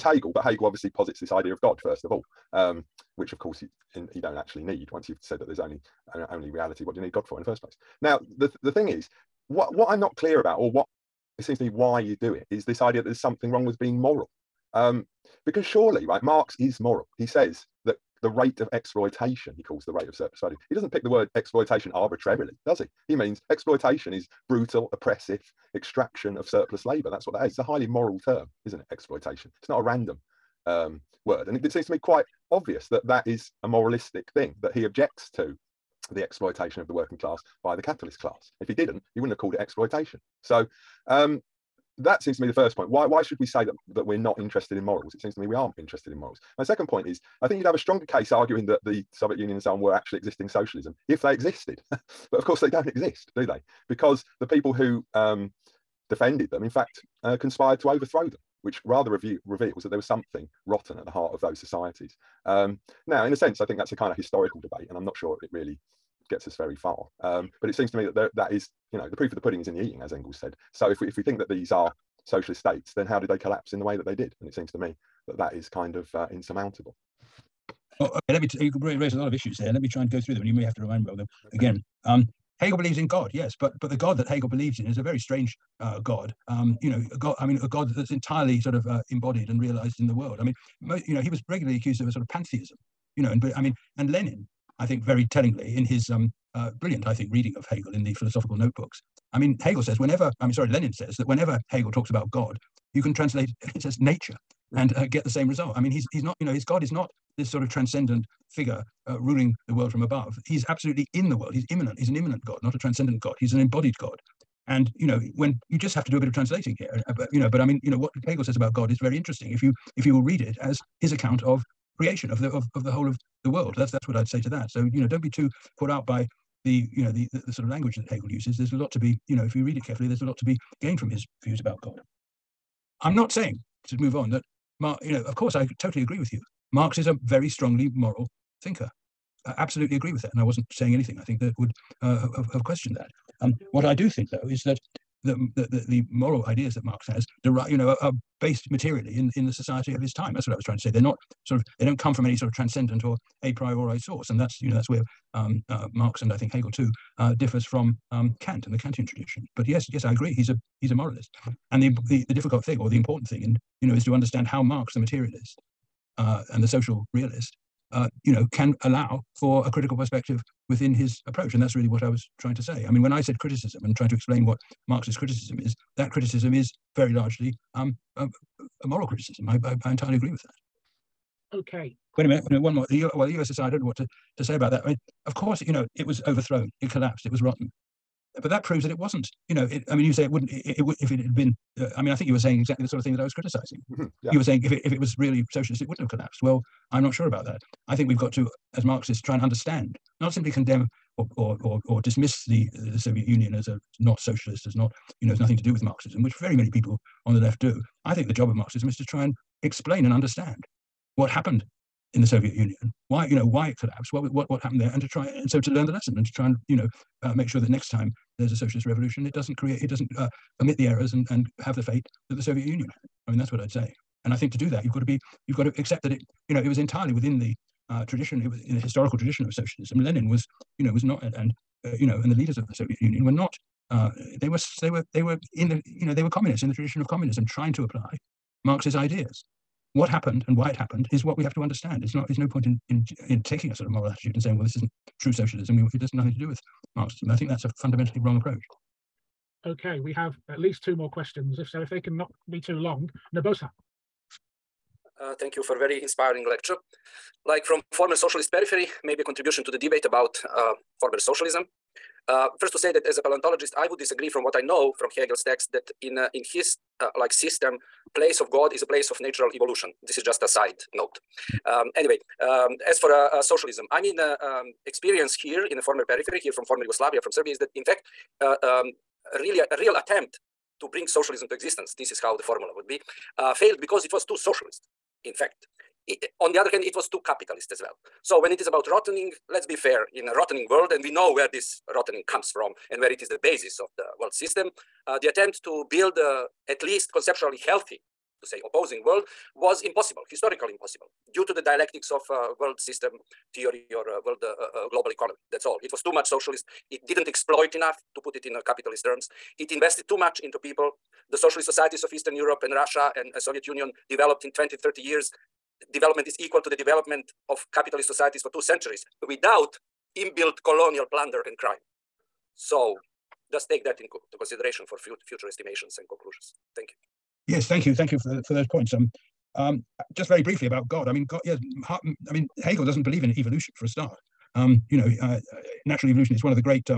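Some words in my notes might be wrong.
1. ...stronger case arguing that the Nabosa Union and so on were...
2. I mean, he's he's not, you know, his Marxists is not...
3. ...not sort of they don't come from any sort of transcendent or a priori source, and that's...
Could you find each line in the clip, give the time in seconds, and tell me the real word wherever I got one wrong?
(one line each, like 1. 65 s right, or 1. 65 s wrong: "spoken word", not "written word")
1. 47 s wrong: "Soviet", not "Nabosa"
2. 105 s wrong: "God", not "Marxists"
3. 151 s right.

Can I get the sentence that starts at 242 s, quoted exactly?
It's not there's no point in in in taking a sort of moral attitude and saying well this isn't true socialism.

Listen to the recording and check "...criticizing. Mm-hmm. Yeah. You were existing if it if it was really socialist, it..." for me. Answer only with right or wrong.
wrong.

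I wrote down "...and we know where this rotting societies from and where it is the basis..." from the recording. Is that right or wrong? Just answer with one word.
wrong.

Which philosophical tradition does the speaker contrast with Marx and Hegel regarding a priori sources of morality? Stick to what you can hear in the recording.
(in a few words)
Kantian tradition.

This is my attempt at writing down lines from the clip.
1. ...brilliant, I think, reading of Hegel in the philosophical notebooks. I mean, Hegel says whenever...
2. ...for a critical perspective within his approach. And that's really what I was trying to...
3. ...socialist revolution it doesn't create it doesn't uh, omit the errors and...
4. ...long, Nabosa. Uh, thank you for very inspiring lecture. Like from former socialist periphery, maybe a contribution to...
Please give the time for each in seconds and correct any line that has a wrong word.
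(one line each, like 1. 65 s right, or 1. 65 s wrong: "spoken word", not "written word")
1. 96 s right
2. 169 s right
3. 218 s right
4. 252 s right.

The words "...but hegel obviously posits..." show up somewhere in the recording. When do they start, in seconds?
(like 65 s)
0 s.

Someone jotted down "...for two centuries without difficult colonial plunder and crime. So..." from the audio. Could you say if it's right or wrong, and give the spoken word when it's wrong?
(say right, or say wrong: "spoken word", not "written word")
wrong: "inbuilt", not "difficult".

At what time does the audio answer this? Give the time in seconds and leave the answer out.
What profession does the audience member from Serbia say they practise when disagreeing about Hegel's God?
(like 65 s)
263 s.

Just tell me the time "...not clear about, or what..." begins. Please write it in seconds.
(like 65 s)
9 s.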